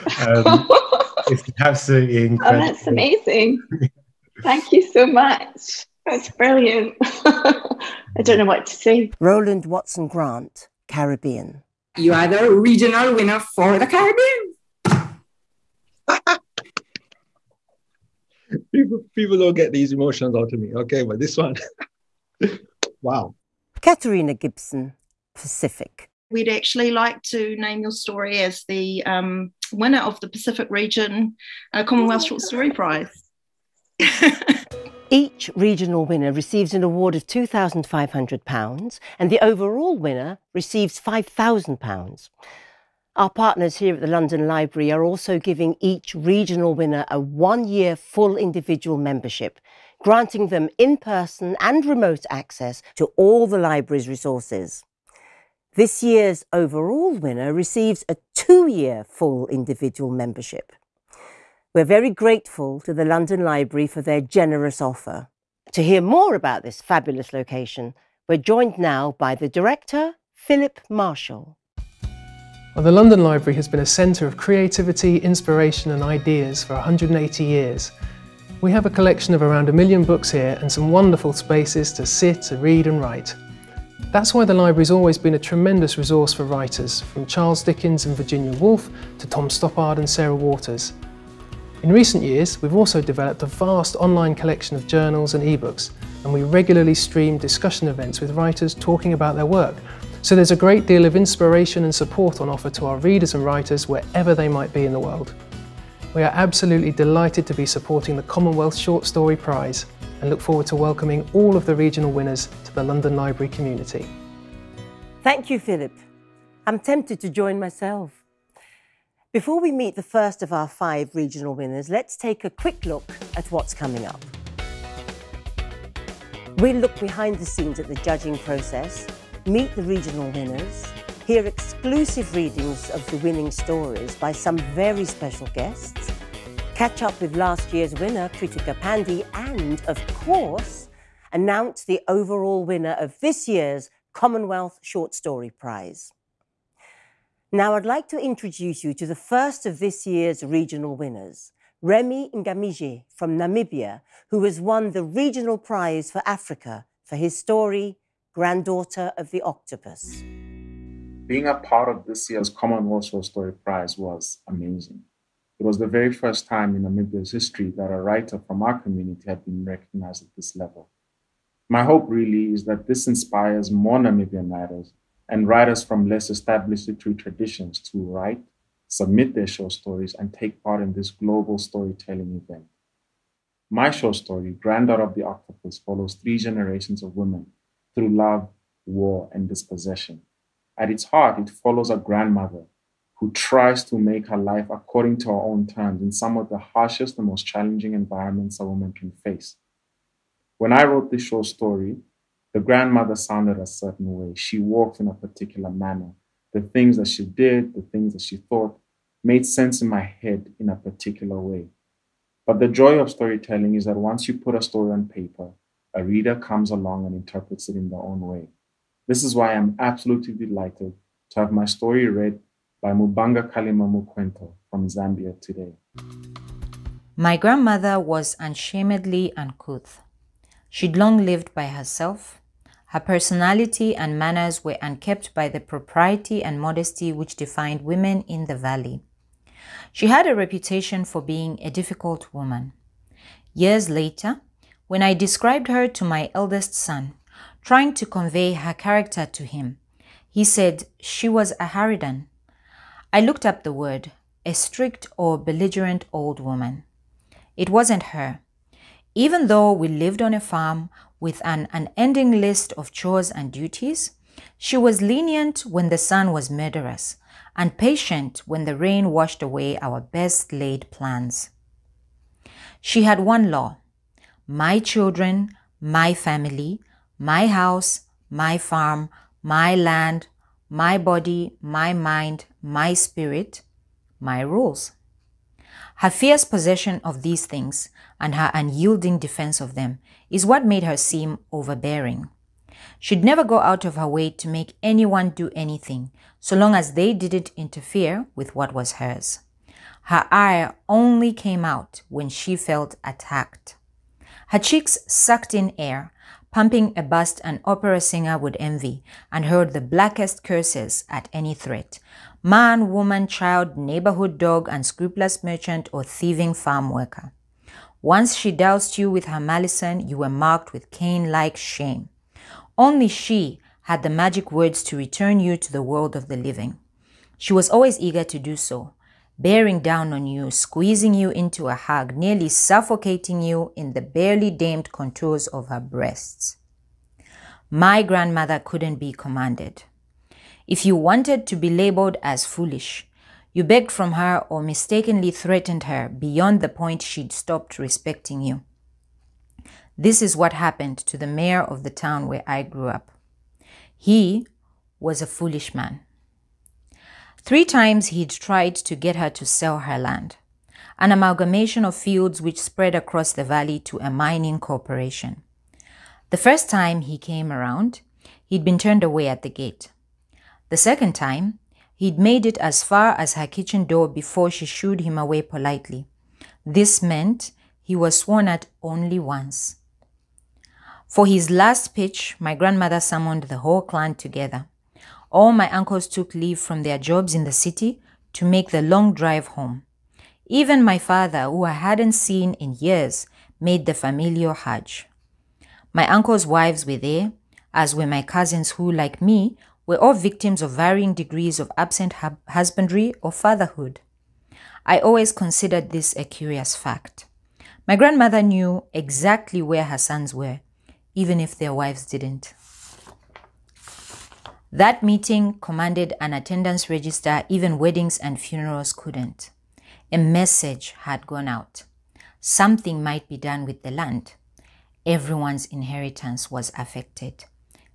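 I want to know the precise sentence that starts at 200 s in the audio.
When I wrote this short story, the grandmother sounded a certain way.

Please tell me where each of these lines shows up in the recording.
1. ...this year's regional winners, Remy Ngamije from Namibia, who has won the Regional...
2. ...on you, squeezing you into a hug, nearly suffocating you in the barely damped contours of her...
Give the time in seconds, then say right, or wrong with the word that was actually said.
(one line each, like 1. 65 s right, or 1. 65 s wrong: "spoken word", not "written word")
1. 149 s right
2. 330 s right.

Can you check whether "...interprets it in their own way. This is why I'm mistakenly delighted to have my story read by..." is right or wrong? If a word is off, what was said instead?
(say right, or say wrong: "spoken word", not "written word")
wrong: "absolutely", not "mistakenly".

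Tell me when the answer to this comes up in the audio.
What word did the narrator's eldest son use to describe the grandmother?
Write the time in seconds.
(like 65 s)
251 s.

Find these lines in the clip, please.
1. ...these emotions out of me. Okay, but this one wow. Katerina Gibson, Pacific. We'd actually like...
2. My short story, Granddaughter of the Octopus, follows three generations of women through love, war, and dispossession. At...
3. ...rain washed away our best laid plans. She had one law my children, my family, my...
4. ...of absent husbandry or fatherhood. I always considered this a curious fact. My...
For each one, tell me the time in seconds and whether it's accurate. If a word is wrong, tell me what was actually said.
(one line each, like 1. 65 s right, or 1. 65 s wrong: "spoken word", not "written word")
1. 19 s right
2. 183 s right
3. 268 s right
4. 401 s right.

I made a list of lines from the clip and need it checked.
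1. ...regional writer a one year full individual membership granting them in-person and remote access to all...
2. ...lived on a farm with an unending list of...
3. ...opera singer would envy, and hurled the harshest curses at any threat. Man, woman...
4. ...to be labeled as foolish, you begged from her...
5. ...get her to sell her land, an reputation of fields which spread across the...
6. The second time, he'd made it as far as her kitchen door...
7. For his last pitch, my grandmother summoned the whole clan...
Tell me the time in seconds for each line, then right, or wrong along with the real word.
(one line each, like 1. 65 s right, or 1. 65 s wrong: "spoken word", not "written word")
1. 46 s wrong: "winner", not "writer"
2. 259 s right
3. 307 s wrong: "blackest", not "harshest"
4. 341 s right
5. 358 s wrong: "amalgamation", not "reputation"
6. 370 s right
7. 381 s right.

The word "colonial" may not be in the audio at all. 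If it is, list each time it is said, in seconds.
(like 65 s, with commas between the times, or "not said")
not said.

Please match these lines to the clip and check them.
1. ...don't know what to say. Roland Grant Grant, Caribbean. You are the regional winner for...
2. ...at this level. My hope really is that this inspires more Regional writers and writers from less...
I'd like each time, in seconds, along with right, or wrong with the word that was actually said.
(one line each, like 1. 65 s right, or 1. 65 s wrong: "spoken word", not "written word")
1. 8 s wrong: "Watson", not "Grant"
2. 170 s wrong: "Namibian", not "Regional".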